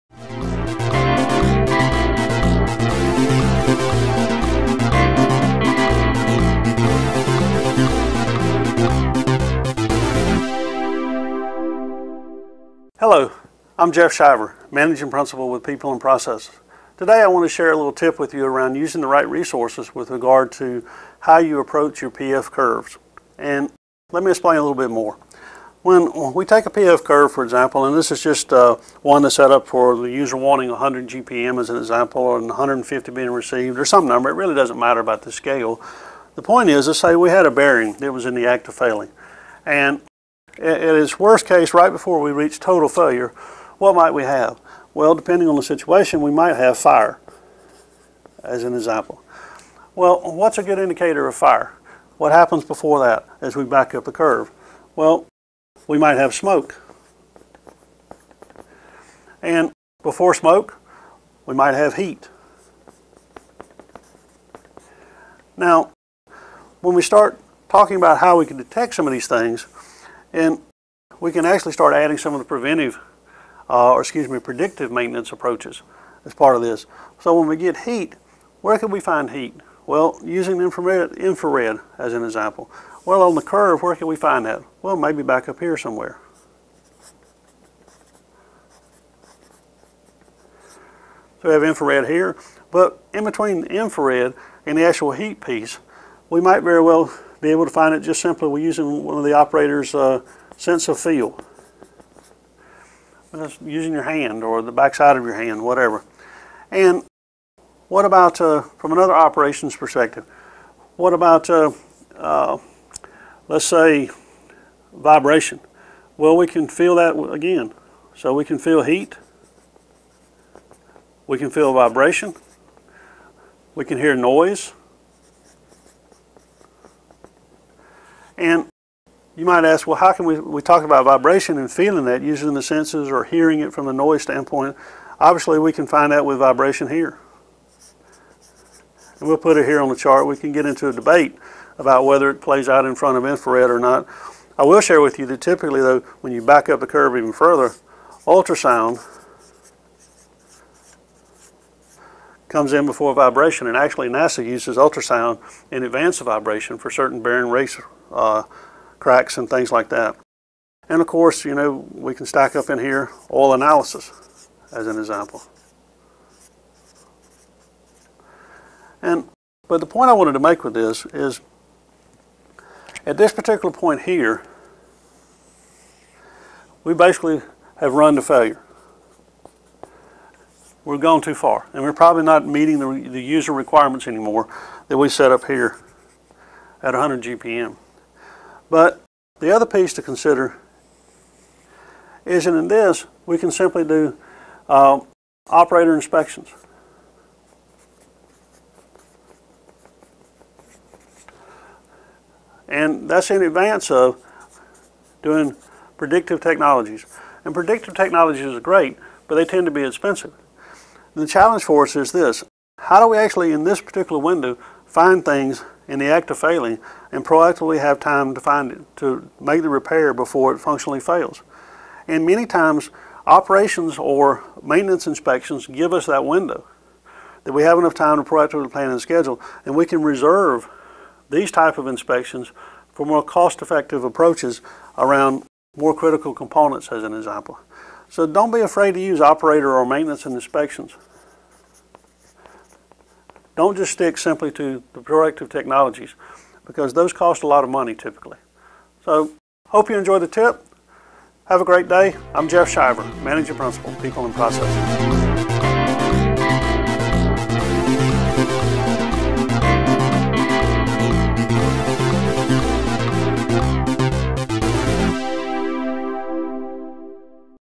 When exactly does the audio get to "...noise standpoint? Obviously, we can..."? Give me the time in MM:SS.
02:13.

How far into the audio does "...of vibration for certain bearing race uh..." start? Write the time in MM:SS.
02:36.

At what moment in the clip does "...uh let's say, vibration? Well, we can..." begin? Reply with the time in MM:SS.
01:52.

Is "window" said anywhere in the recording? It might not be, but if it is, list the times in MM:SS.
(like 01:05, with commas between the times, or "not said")
03:34, 03:46.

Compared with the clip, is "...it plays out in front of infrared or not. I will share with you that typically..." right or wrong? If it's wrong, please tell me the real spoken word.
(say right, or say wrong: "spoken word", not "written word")
right.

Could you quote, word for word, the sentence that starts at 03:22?
And that's in advance of doing predictive technologies.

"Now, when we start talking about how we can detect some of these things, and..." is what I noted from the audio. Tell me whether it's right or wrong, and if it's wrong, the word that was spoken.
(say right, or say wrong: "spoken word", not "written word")
right.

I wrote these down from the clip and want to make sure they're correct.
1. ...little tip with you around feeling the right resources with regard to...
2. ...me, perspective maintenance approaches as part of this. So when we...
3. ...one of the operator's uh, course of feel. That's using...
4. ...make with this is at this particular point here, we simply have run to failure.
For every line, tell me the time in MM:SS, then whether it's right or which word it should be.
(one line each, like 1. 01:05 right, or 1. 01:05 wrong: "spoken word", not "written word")
1. 00:17 wrong: "using", not "feeling"
2. 01:14 wrong: "predictive", not "perspective"
3. 01:39 wrong: "sense", not "course"
4. 02:50 wrong: "basically", not "simply".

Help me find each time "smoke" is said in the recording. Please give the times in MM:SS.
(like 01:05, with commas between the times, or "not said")
00:56, 01:00.